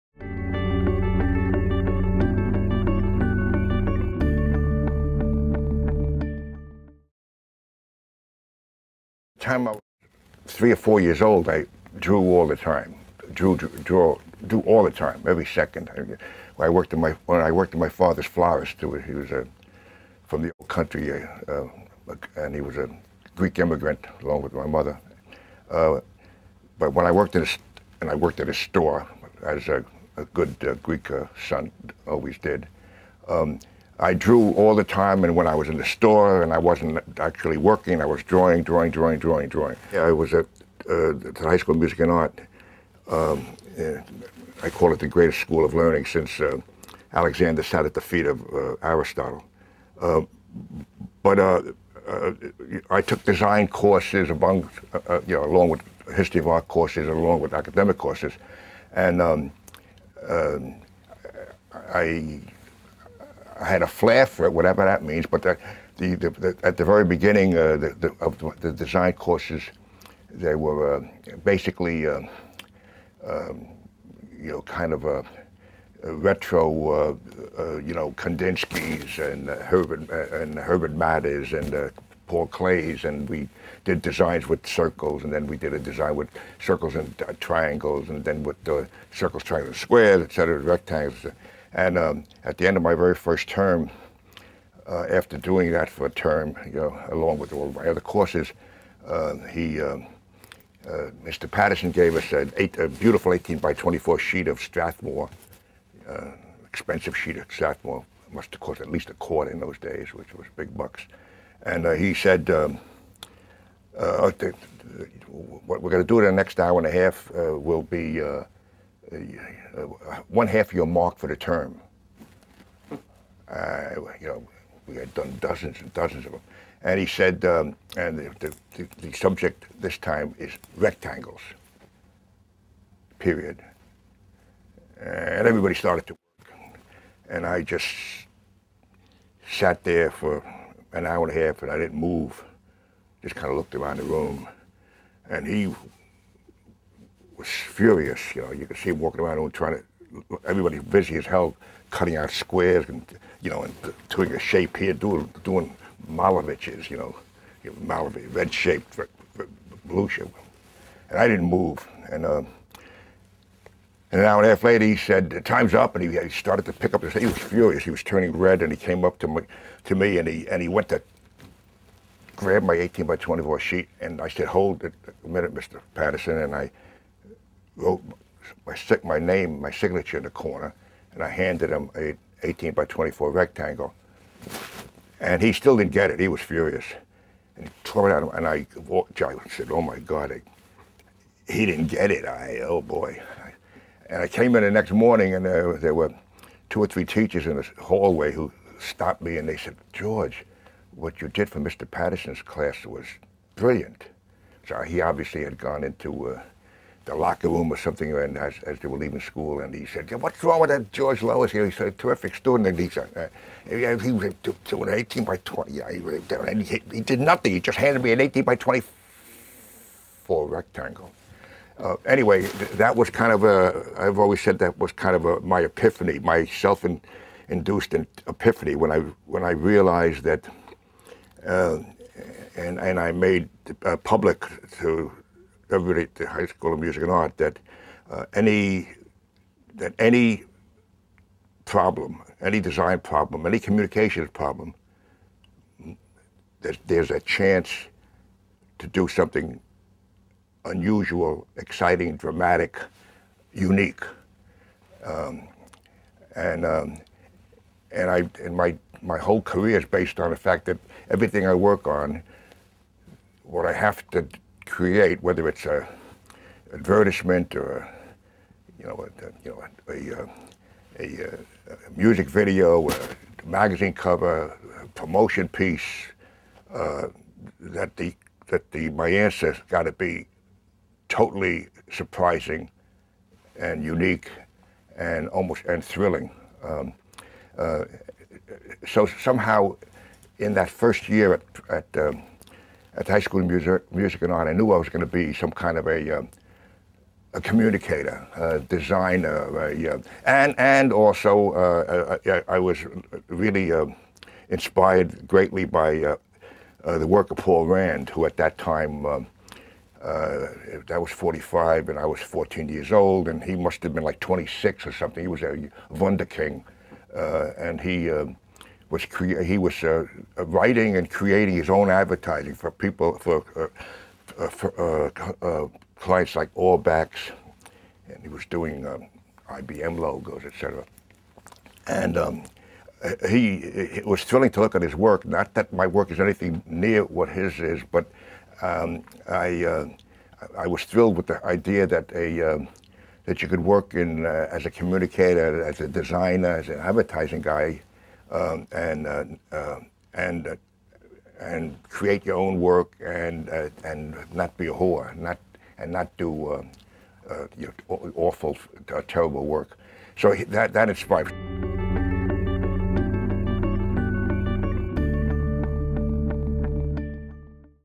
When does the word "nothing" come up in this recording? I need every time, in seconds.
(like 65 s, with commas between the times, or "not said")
217 s.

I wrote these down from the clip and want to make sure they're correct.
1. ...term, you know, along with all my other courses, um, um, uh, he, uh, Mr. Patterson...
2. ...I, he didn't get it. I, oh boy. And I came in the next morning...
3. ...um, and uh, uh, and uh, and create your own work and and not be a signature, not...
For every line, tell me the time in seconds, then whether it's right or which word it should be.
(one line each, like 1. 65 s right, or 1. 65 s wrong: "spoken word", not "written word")
1. 96 s right
2. 190 s right
3. 348 s wrong: "whore", not "signature".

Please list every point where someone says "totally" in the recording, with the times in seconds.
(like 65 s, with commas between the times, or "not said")
281 s.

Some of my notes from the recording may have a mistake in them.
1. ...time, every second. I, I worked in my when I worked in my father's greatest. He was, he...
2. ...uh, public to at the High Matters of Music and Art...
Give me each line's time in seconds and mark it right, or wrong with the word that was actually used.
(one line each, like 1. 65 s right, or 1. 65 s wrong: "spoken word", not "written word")
1. 14 s wrong: "florist", not "greatest"
2. 233 s wrong: "School", not "Matters".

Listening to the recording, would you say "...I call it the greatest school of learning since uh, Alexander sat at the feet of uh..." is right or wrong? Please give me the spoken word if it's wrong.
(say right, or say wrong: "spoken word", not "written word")
right.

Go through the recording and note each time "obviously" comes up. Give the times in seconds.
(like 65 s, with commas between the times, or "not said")
205 s.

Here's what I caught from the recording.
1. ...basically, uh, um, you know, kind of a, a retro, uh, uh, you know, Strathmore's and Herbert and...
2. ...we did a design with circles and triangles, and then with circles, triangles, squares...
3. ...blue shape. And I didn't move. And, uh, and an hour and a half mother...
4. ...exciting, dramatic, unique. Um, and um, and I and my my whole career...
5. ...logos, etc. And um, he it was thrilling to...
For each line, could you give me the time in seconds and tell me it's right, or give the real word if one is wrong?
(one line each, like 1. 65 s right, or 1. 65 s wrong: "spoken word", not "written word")
1. 71 s wrong: "Kandinsky", not "Strathmore"
2. 85 s right
3. 159 s wrong: "later", not "mother"
4. 251 s right
5. 329 s right.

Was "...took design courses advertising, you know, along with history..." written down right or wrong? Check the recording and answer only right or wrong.
wrong.